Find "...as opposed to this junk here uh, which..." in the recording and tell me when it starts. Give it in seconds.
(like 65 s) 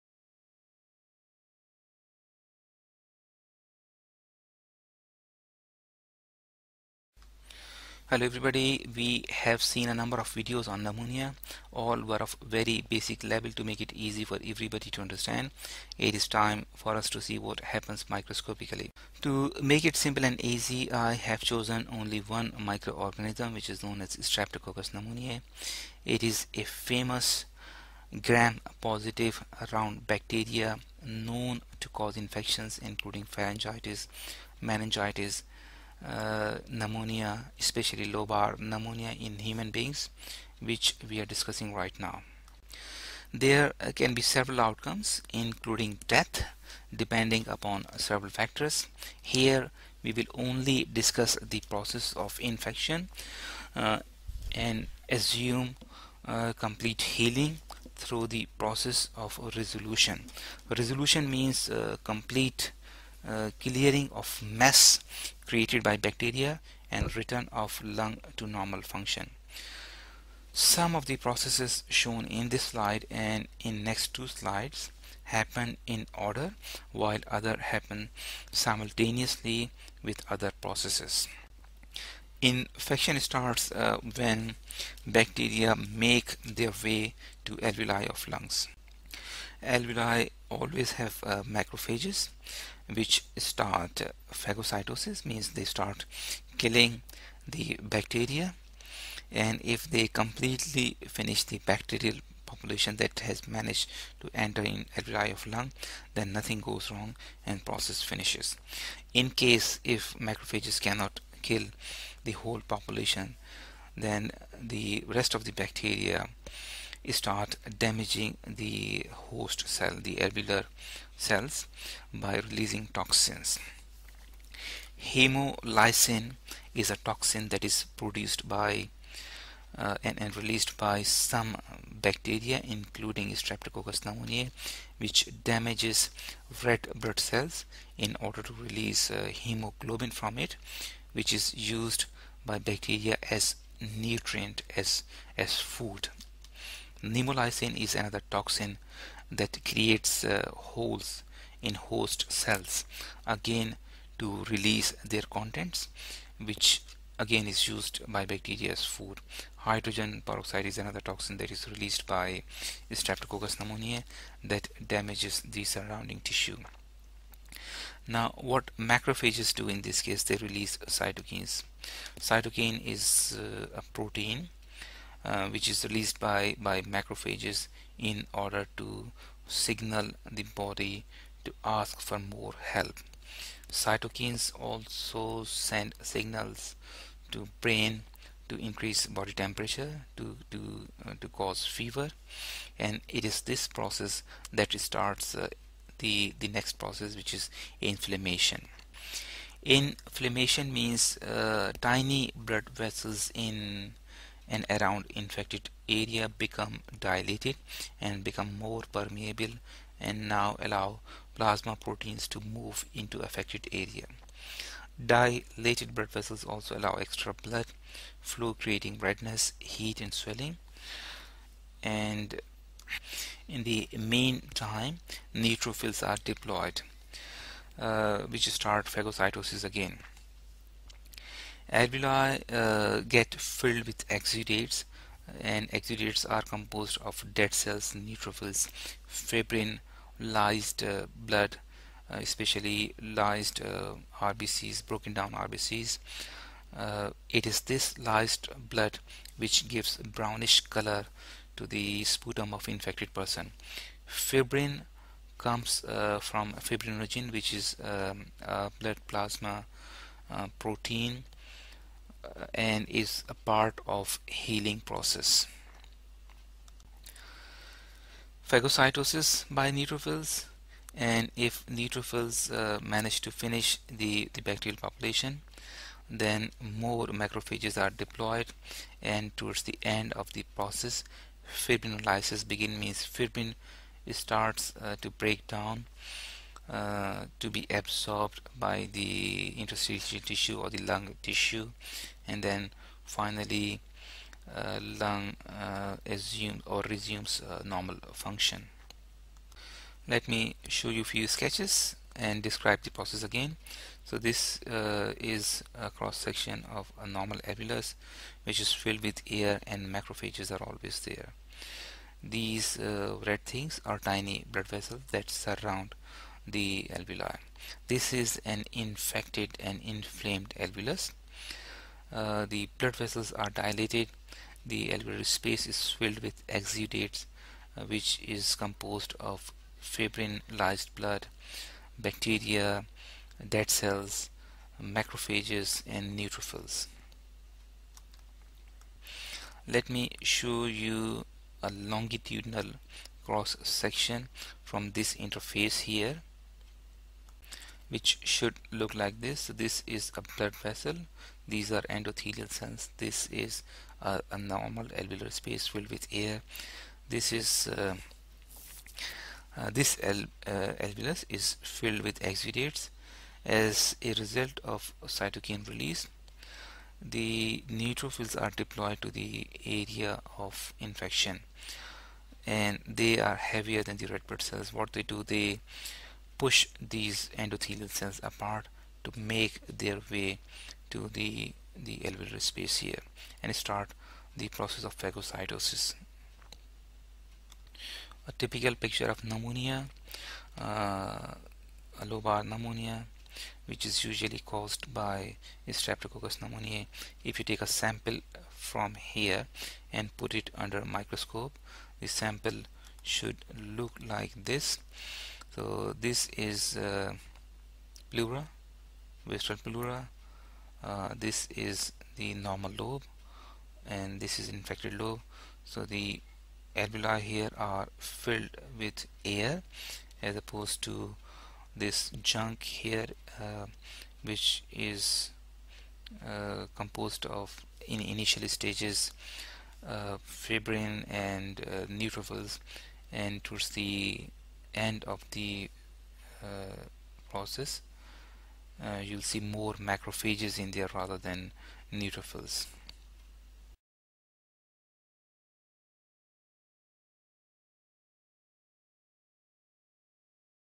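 420 s.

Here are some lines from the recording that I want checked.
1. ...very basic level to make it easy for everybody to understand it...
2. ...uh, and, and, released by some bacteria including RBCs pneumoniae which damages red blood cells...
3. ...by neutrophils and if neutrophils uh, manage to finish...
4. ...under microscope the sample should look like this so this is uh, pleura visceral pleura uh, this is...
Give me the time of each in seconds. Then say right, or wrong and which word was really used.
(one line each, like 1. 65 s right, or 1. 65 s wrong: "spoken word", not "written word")
1. 12 s right
2. 129 s wrong: "Streptococcus", not "RBCs"
3. 269 s right
4. 400 s right.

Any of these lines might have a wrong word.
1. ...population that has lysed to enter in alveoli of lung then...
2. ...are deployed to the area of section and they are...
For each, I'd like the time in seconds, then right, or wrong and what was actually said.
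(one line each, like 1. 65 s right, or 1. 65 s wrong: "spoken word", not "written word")
1. 102 s wrong: "managed", not "lysed"
2. 368 s wrong: "infection", not "section".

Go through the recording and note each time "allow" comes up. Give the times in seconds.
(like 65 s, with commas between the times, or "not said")
210 s, 216 s.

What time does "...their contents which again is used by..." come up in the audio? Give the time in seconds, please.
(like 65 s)
155 s.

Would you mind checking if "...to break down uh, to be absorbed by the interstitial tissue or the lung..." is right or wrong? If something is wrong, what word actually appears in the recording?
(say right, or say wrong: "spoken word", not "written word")
right.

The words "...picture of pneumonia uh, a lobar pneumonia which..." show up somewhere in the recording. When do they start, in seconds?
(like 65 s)
388 s.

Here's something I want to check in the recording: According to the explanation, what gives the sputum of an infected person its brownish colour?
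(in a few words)
lysed blood.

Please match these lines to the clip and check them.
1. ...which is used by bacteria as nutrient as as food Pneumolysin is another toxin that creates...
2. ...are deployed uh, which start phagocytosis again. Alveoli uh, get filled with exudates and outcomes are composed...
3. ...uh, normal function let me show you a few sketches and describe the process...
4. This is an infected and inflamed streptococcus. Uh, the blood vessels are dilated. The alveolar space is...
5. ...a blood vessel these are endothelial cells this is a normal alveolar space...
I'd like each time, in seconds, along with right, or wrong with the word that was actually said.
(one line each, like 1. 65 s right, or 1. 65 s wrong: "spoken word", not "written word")
1. 141 s right
2. 226 s wrong: "exudates", not "outcomes"
3. 297 s right
4. 317 s wrong: "alveolus", not "streptococcus"
5. 350 s right.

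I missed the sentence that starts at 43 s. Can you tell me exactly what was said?
There can be several outcomes, including death, depending upon several factors.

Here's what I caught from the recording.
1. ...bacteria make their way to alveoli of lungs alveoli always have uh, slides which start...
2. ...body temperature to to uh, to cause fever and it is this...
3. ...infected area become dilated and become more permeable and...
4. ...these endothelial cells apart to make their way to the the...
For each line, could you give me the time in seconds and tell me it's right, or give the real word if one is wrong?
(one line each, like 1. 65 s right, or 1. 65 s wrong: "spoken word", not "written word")
1. 85 s wrong: "macrophages", not "slides"
2. 189 s right
3. 205 s right
4. 376 s right.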